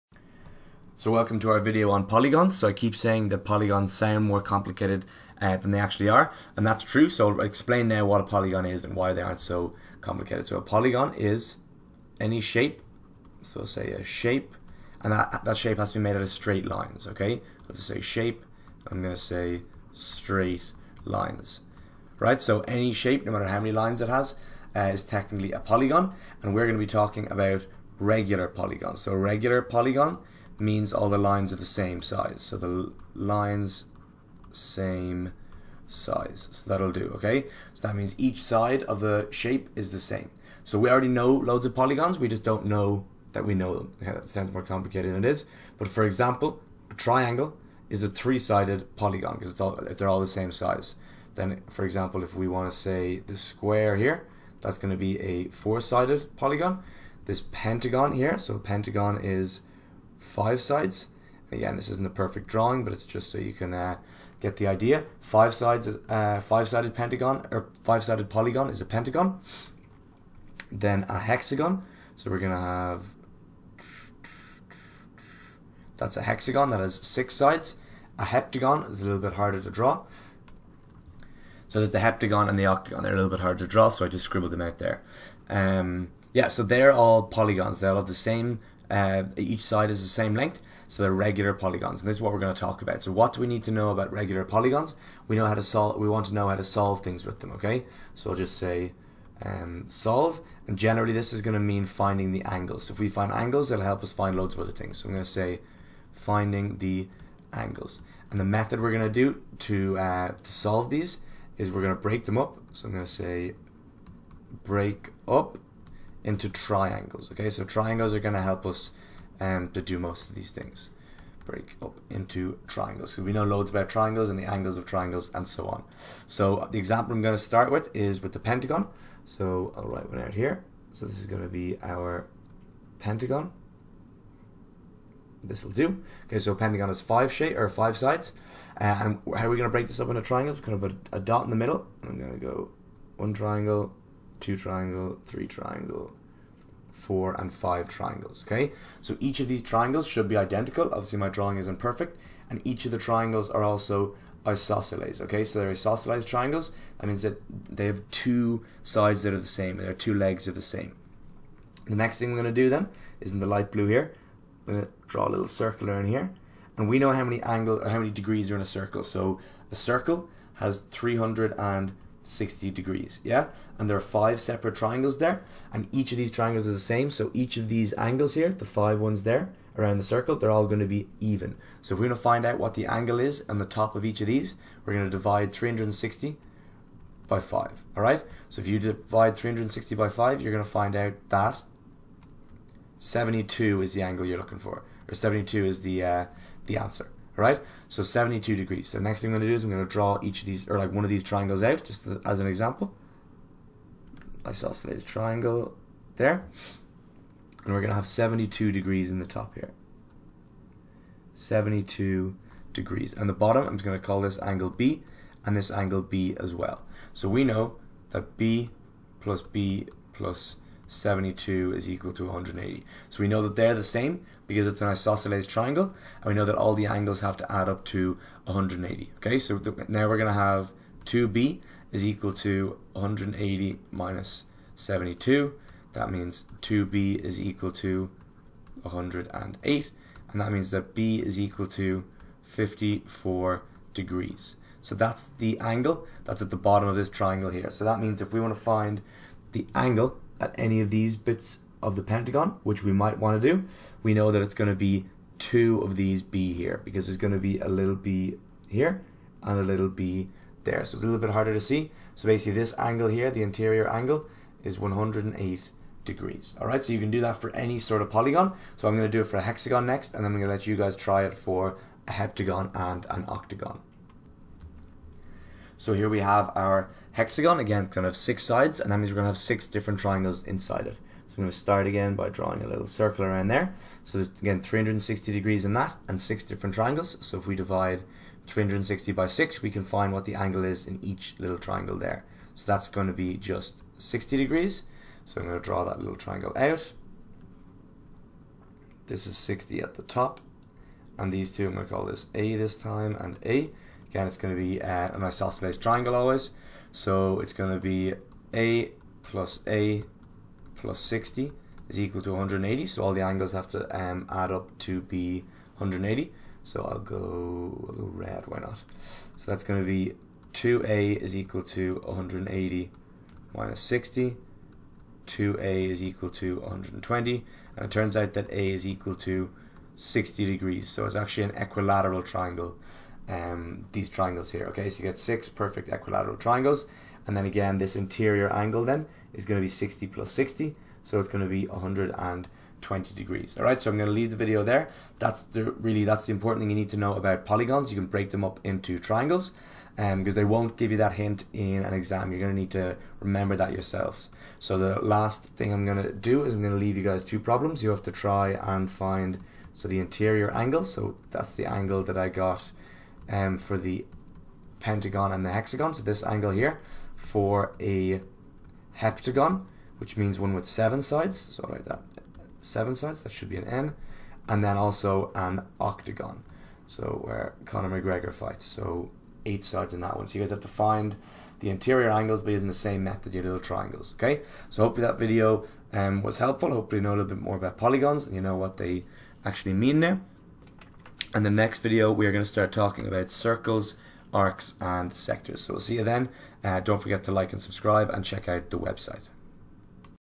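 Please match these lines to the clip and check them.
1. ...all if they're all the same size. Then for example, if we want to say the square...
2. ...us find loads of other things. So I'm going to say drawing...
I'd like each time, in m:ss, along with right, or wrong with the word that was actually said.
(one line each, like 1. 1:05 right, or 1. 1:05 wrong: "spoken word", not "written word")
1. 0:49 right
2. 1:44 wrong: "finding", not "drawing".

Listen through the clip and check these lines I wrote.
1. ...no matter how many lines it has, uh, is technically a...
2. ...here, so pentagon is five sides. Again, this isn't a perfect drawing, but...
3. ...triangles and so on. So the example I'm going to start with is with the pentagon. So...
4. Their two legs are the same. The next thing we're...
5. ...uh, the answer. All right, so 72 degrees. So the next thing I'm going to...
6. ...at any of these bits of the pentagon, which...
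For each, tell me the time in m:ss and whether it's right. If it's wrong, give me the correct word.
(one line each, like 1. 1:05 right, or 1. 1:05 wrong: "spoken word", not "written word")
1. 0:23 right
2. 0:58 right
3. 2:04 right
4. 2:39 right
5. 3:16 right
6. 4:10 right.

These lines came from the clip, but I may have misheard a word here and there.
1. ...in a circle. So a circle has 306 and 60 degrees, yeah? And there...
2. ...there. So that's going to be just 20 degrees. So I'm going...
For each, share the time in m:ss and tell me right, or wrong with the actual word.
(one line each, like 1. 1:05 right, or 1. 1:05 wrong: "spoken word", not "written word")
1. 2:48 wrong: "300", not "306"
2. 4:51 wrong: "60", not "20".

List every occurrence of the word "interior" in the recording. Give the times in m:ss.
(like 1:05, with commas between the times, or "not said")
4:23, 5:37, 5:59, 6:21.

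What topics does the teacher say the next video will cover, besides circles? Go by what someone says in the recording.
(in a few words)
Arcs and sectors.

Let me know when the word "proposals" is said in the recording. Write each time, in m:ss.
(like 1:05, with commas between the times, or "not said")
not said.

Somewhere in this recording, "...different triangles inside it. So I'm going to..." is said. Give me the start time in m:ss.
4:39.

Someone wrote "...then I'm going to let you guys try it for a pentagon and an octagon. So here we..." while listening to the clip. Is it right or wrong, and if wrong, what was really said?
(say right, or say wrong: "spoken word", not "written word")
wrong: "heptagon", not "pentagon".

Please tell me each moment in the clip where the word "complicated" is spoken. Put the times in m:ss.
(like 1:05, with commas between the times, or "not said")
0:04, 0:10, 0:44.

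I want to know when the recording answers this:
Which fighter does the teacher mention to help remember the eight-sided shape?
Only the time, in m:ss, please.
6:17.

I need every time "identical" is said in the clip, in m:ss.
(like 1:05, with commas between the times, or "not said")
2:30.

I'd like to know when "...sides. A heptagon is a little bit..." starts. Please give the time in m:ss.
1:17.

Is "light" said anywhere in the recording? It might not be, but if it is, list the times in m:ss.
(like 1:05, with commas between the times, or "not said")
2:43.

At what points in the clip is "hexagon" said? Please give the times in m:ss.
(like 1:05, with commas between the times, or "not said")
1:11, 1:16, 4:29, 4:37, 6:05.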